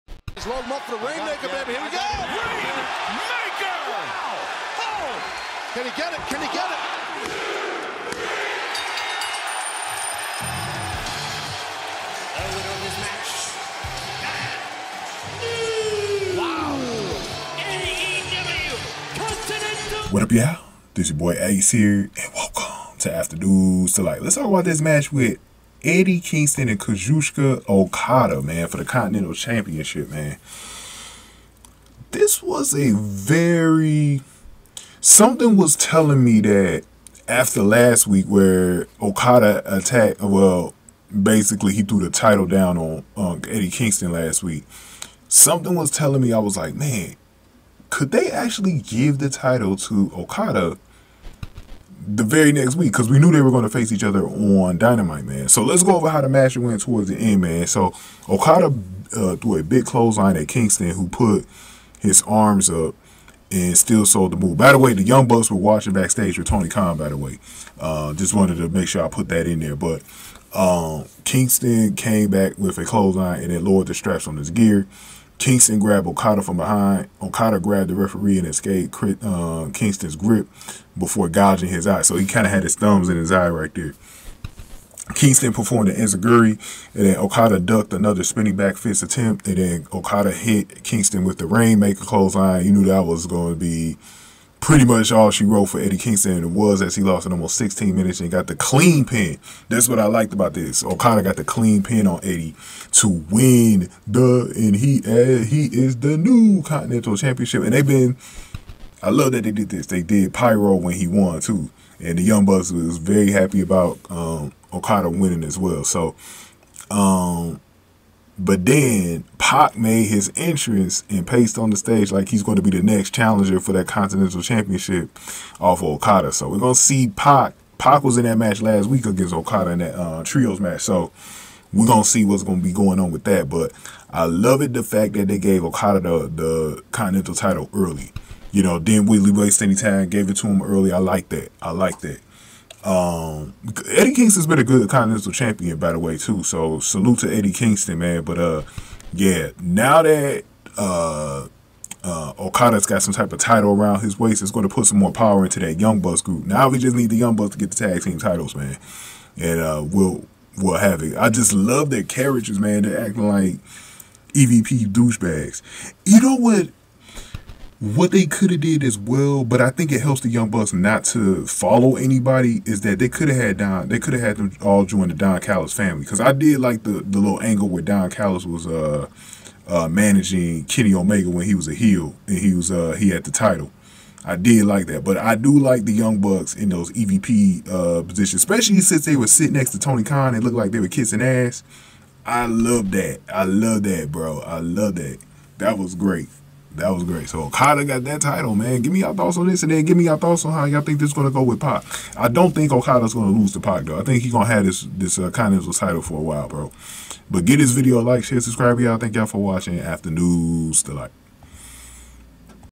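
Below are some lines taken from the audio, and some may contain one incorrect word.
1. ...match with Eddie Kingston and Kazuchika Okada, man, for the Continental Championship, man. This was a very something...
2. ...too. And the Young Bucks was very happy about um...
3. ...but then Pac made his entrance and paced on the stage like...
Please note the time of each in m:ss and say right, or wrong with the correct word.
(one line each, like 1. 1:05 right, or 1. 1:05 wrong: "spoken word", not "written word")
1. 0:24 right
2. 1:51 right
3. 1:58 right.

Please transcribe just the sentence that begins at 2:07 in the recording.
Pac was in that match last week against Okada in that uh, trios match.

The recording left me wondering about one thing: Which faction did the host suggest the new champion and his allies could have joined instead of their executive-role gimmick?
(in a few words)
The Don Callis family.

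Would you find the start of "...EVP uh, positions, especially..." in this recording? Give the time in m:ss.
3:06.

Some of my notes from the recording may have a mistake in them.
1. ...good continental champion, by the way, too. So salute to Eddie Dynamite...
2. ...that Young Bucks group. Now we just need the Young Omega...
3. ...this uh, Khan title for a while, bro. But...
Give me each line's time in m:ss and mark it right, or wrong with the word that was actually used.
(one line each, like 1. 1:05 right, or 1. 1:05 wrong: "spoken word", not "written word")
1. 2:24 wrong: "Kingston", not "Dynamite"
2. 2:35 wrong: "Bucks", not "Omega"
3. 3:24 wrong: "Continental", not "Khan".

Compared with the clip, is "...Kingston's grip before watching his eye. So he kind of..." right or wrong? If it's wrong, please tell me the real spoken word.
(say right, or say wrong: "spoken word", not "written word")
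wrong: "gouging", not "watching".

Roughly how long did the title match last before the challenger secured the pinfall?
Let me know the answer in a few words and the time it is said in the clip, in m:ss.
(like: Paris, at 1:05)
Almost 16 minutes, at 1:37.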